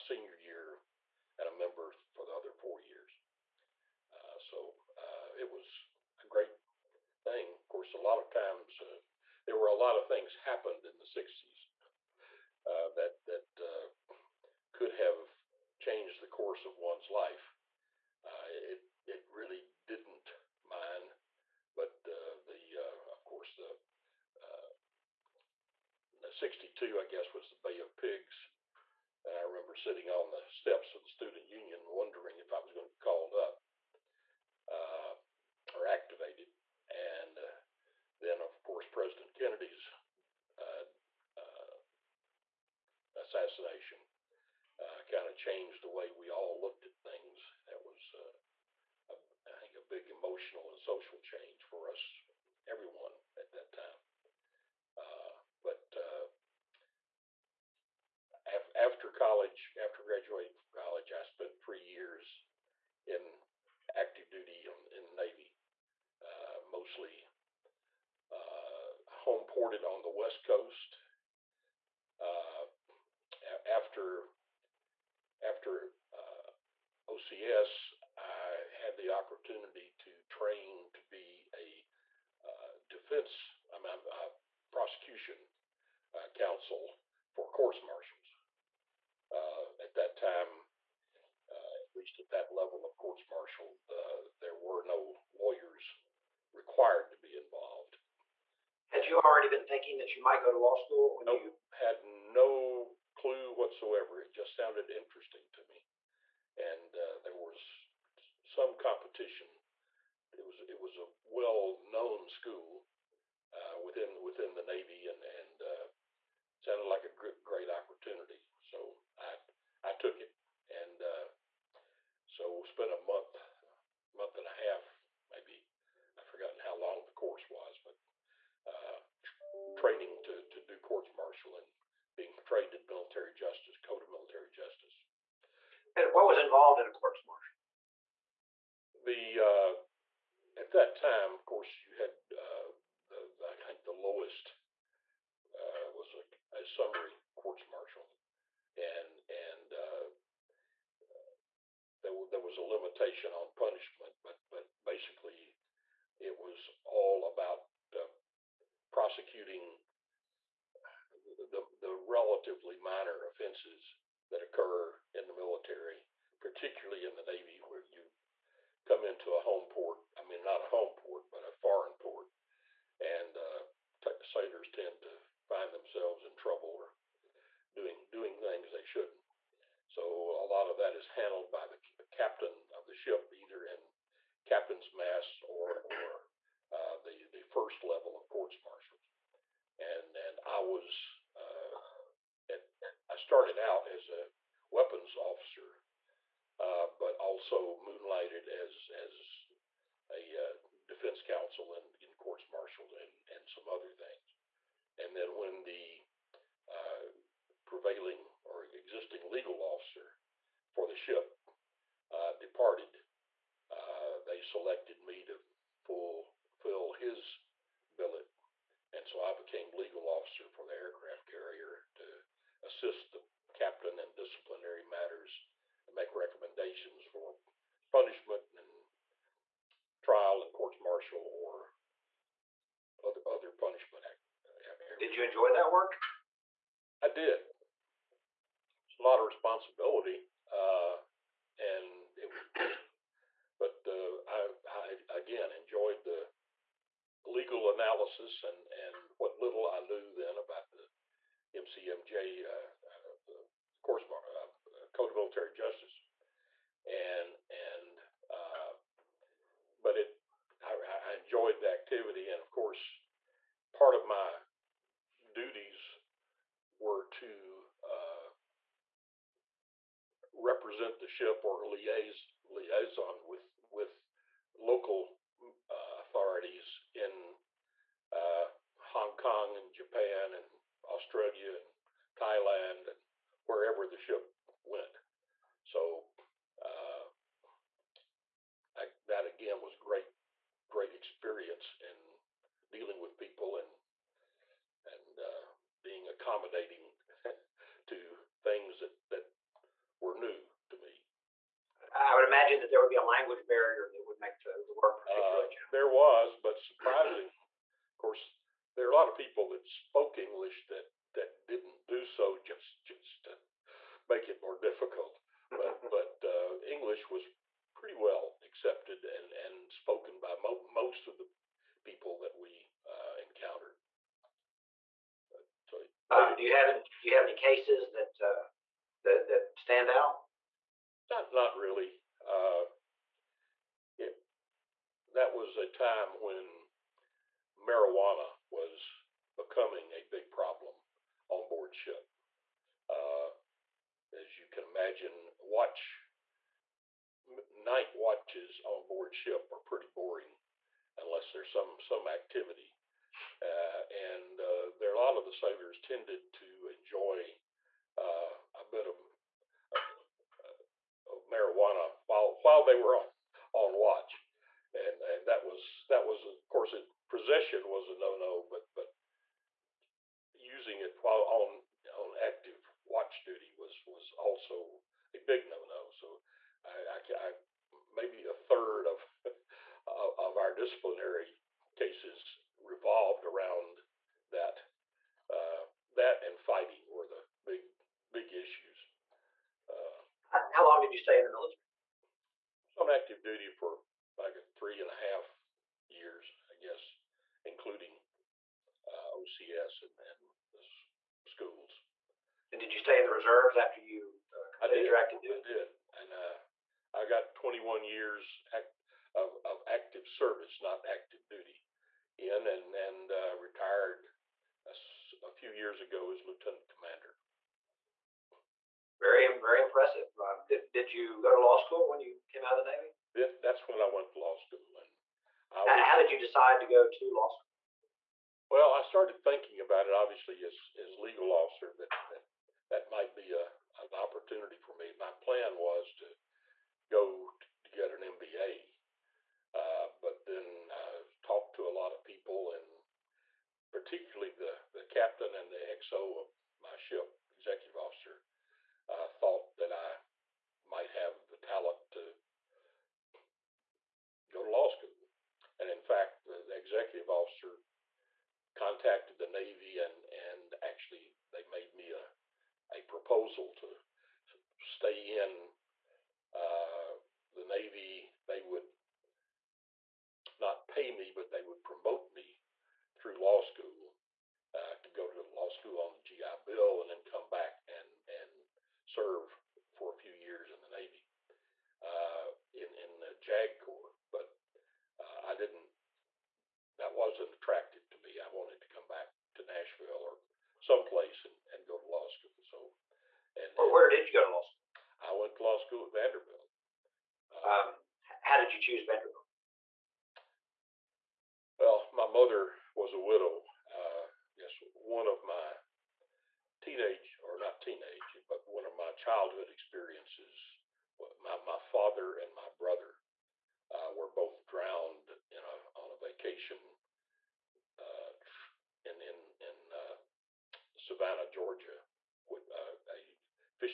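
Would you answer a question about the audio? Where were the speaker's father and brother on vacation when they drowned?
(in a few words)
Savannah, Georgia.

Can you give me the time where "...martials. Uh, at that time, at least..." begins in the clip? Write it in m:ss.
1:27.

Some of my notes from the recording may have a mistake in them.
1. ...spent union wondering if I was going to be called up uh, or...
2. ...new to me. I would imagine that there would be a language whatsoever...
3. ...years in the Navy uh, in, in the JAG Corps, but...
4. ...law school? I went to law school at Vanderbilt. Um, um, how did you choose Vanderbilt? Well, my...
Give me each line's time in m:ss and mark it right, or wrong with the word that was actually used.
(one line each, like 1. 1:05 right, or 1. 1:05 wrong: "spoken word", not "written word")
1. 0:31 wrong: "student", not "spent"
2. 5:00 wrong: "barrier", not "whatsoever"
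3. 8:00 right
4. 8:14 right.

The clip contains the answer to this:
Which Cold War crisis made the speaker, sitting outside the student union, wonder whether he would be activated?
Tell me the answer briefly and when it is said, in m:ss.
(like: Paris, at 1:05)
Bay of Pigs, at 0:27.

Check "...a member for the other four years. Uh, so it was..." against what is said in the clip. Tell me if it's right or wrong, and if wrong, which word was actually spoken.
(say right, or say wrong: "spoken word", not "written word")
right.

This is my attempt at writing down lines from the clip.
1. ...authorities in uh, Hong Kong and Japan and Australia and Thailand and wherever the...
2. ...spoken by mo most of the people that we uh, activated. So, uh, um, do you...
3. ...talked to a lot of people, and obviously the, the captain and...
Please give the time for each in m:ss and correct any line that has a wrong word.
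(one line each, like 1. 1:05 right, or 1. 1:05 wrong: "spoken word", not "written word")
1. 4:36 right
2. 5:19 wrong: "encountered", not "activated"
3. 7:21 wrong: "particularly", not "obviously".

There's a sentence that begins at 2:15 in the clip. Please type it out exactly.
And what was involved in a courts martial?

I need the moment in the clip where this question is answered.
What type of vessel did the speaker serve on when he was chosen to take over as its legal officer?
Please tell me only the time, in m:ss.
3:40.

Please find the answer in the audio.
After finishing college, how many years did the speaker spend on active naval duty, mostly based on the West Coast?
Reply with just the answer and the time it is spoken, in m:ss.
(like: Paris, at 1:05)
3, at 1:01.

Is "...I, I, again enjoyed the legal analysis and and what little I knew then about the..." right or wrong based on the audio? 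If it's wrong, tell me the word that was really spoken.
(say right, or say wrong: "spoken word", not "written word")
right.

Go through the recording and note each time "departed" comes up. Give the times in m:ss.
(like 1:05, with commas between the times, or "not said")
3:32.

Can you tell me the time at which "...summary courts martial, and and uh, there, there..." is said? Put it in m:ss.
2:26.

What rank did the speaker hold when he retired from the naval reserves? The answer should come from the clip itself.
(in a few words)
lieutenant commander.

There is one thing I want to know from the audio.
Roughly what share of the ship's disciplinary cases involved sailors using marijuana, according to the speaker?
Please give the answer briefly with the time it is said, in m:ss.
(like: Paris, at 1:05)
a third, at 6:18.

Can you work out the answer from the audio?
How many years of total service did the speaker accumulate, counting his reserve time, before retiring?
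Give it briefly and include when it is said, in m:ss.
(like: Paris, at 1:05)
21, at 6:47.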